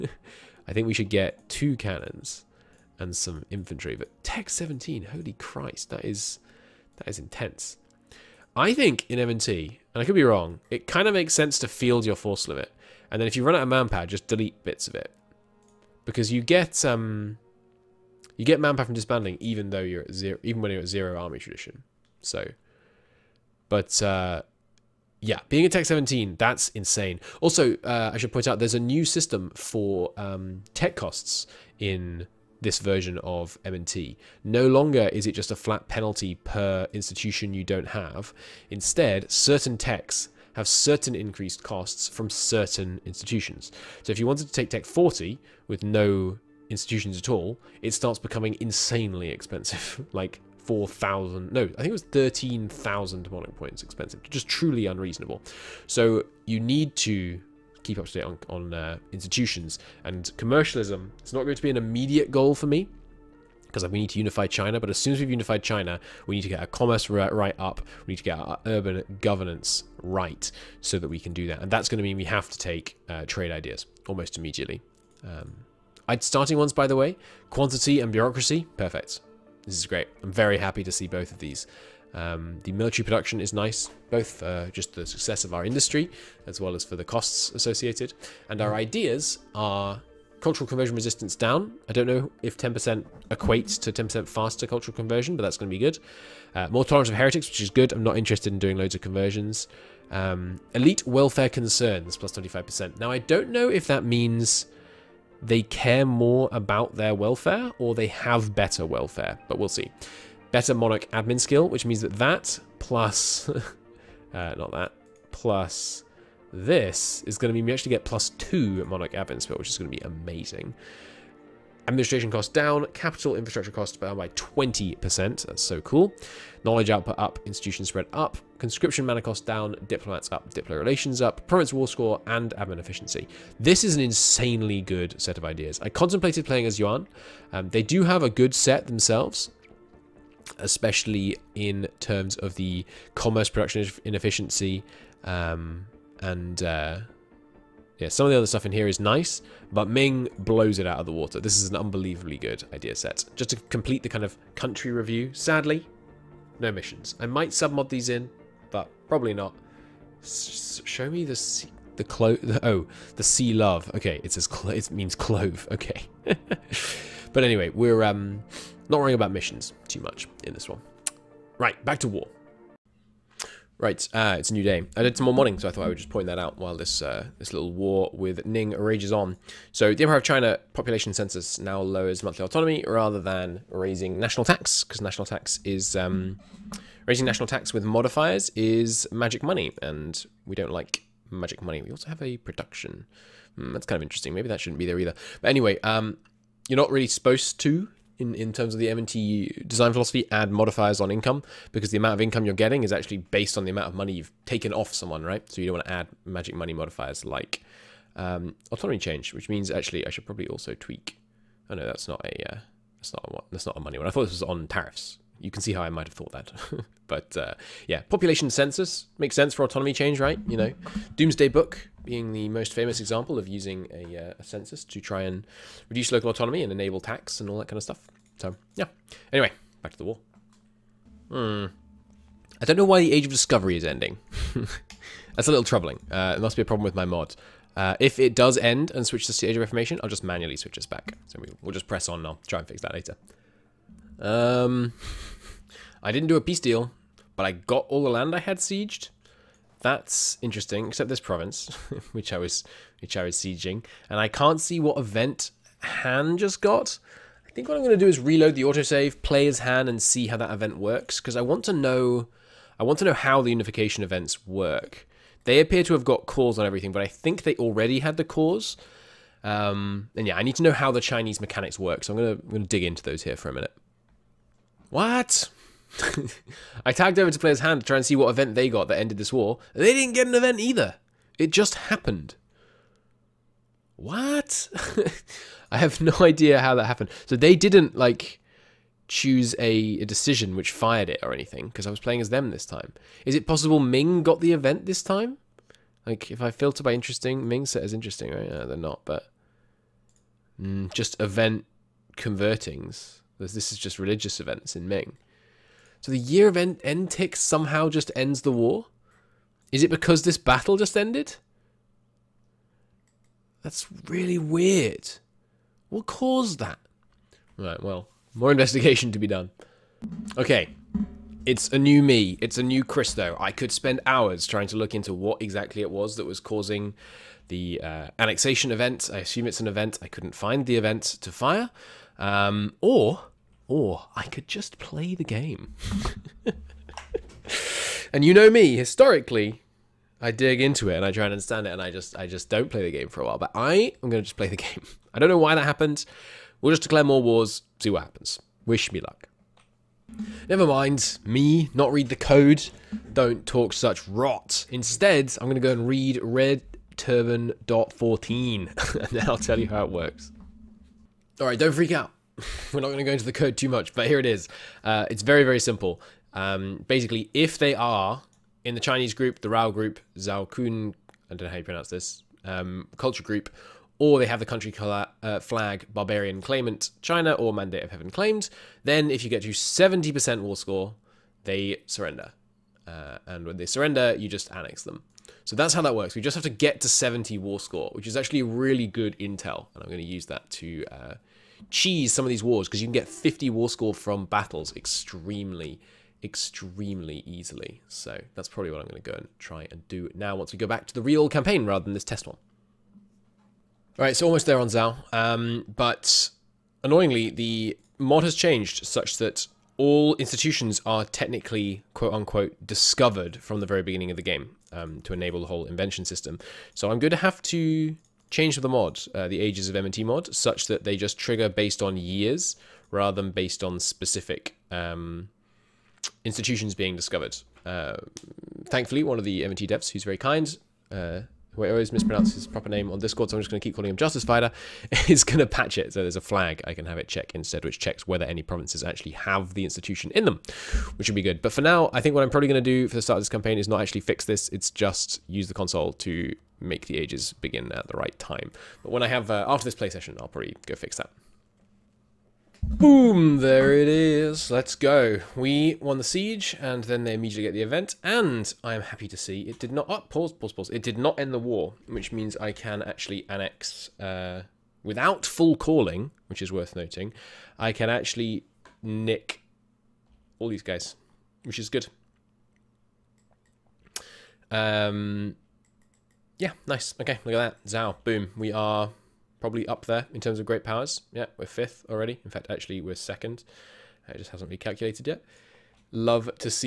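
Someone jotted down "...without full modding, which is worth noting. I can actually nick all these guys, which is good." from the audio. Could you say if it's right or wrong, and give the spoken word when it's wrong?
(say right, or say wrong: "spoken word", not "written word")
wrong: "calling", not "modding".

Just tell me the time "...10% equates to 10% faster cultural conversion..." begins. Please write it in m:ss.
1:32.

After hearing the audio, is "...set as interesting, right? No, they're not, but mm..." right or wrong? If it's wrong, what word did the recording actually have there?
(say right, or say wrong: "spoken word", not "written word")
right.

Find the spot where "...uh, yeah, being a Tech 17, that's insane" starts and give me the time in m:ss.
0:24.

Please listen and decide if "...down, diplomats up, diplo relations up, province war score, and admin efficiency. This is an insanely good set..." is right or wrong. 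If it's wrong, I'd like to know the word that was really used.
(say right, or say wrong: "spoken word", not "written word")
right.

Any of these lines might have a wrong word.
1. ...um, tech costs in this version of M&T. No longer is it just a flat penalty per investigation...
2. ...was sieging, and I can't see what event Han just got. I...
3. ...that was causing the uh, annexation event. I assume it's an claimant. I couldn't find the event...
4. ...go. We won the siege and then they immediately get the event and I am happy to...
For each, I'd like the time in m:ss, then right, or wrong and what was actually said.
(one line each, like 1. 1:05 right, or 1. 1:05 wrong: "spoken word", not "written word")
1. 0:30 wrong: "institution", not "investigation"
2. 4:13 right
3. 5:26 wrong: "event", not "claimant"
4. 7:34 right.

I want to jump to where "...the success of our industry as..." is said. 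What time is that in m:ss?
1:24.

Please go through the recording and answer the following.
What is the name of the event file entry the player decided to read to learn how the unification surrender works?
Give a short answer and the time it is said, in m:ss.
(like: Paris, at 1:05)
Red Turban.14, at 5:56.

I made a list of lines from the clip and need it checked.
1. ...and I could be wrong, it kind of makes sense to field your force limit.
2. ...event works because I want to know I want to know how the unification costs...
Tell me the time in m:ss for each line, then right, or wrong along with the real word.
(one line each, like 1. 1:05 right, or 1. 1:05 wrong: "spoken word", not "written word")
1. 0:09 right
2. 4:20 wrong: "events", not "costs".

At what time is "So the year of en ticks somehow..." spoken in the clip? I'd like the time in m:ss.
5:06.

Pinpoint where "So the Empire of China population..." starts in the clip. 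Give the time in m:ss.
2:59.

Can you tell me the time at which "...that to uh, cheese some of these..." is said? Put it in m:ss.
6:30.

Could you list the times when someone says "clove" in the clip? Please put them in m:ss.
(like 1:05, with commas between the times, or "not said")
2:45.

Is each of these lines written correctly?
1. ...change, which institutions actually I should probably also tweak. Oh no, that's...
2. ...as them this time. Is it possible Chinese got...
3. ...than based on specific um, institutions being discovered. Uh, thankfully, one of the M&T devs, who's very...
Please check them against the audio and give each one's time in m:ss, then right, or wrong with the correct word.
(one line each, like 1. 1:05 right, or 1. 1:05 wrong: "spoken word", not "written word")
1. 3:28 wrong: "means", not "institutions"
2. 4:52 wrong: "Ming", not "Chinese"
3. 7:03 right.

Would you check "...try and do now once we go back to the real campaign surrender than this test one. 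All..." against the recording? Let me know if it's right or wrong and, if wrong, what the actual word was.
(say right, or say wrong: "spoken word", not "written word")
wrong: "rather", not "surrender".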